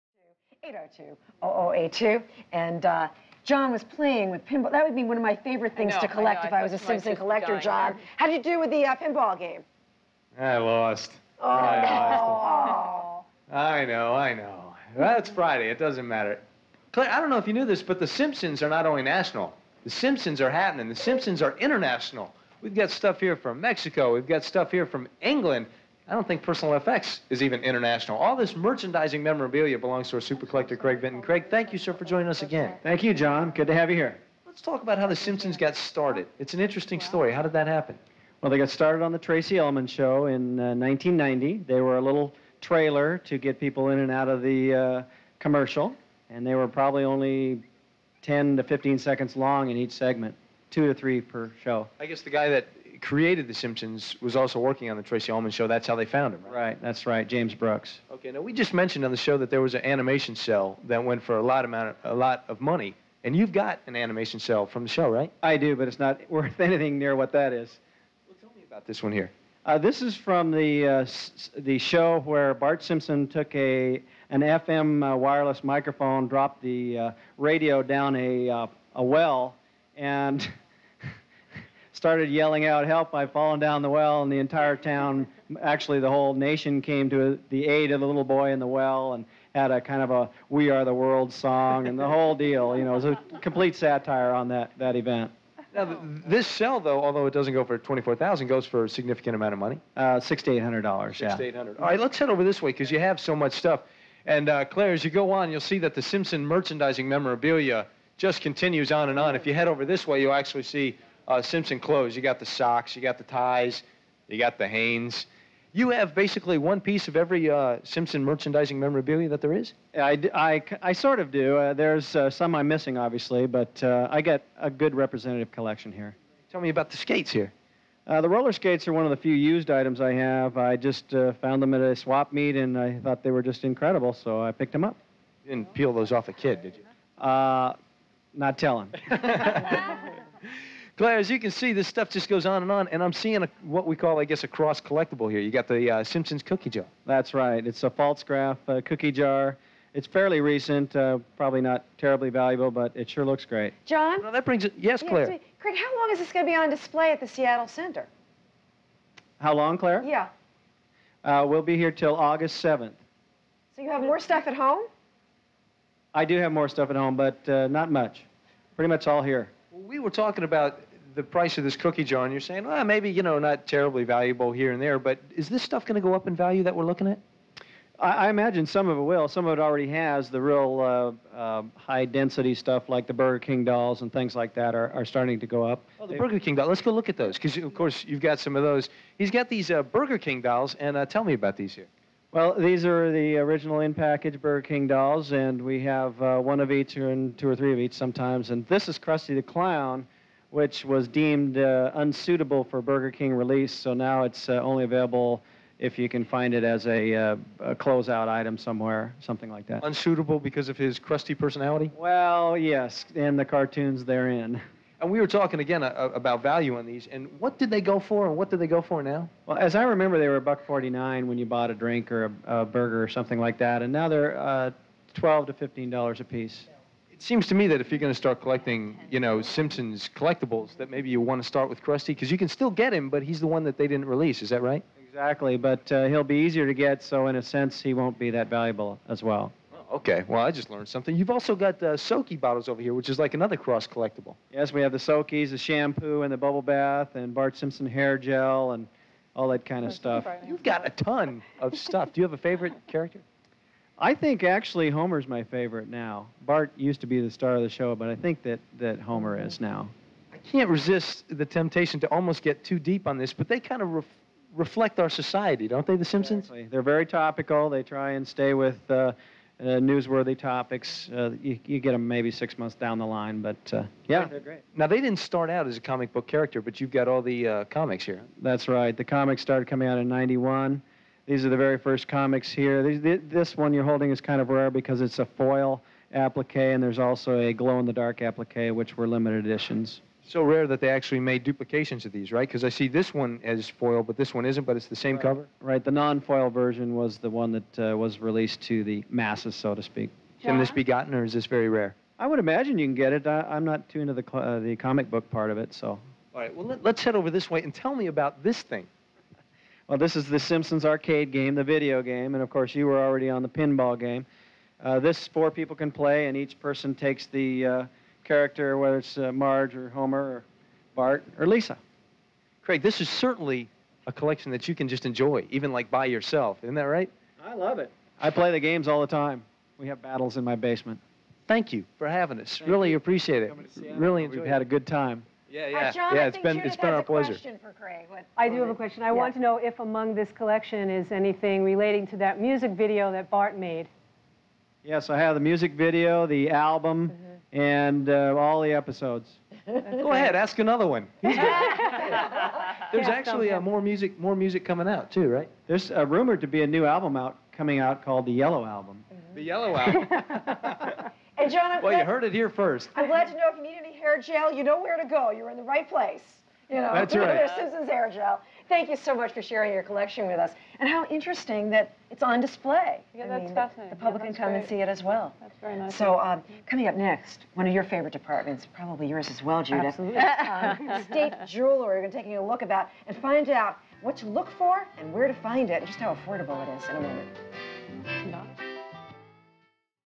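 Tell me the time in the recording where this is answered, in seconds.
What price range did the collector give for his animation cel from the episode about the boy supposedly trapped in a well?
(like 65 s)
100 s.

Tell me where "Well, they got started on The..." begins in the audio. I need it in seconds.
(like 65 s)
38 s.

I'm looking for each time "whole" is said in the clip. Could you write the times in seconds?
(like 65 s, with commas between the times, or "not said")
86 s, 92 s.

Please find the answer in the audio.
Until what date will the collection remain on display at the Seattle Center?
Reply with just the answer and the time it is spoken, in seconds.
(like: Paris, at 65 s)
August 7th, at 162 s.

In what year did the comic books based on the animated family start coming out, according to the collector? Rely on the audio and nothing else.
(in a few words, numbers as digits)
1991.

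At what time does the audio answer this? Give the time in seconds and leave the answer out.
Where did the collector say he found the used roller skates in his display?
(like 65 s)
131 s.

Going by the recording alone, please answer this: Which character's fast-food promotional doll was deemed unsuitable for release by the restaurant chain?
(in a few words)
Krusty the Clown.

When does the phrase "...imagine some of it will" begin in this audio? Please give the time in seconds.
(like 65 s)
178 s.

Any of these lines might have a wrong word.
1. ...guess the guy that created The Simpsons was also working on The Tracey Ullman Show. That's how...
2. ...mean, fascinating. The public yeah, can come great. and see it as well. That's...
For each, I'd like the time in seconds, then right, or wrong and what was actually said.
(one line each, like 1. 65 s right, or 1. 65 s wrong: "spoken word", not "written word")
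1. 52 s right
2. 373 s right.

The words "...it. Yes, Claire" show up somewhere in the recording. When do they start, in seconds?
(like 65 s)
154 s.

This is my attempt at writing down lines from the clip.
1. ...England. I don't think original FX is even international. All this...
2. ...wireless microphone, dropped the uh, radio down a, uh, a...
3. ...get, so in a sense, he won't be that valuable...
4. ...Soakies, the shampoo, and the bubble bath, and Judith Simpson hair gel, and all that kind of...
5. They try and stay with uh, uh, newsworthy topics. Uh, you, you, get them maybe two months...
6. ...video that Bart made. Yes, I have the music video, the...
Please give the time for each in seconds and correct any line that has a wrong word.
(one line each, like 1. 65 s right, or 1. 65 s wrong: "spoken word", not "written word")
1. 25 s wrong: "personal", not "original"
2. 75 s right
3. 236 s right
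4. 244 s wrong: "Bart", not "Judith"
5. 267 s wrong: "six", not "two"
6. 342 s right.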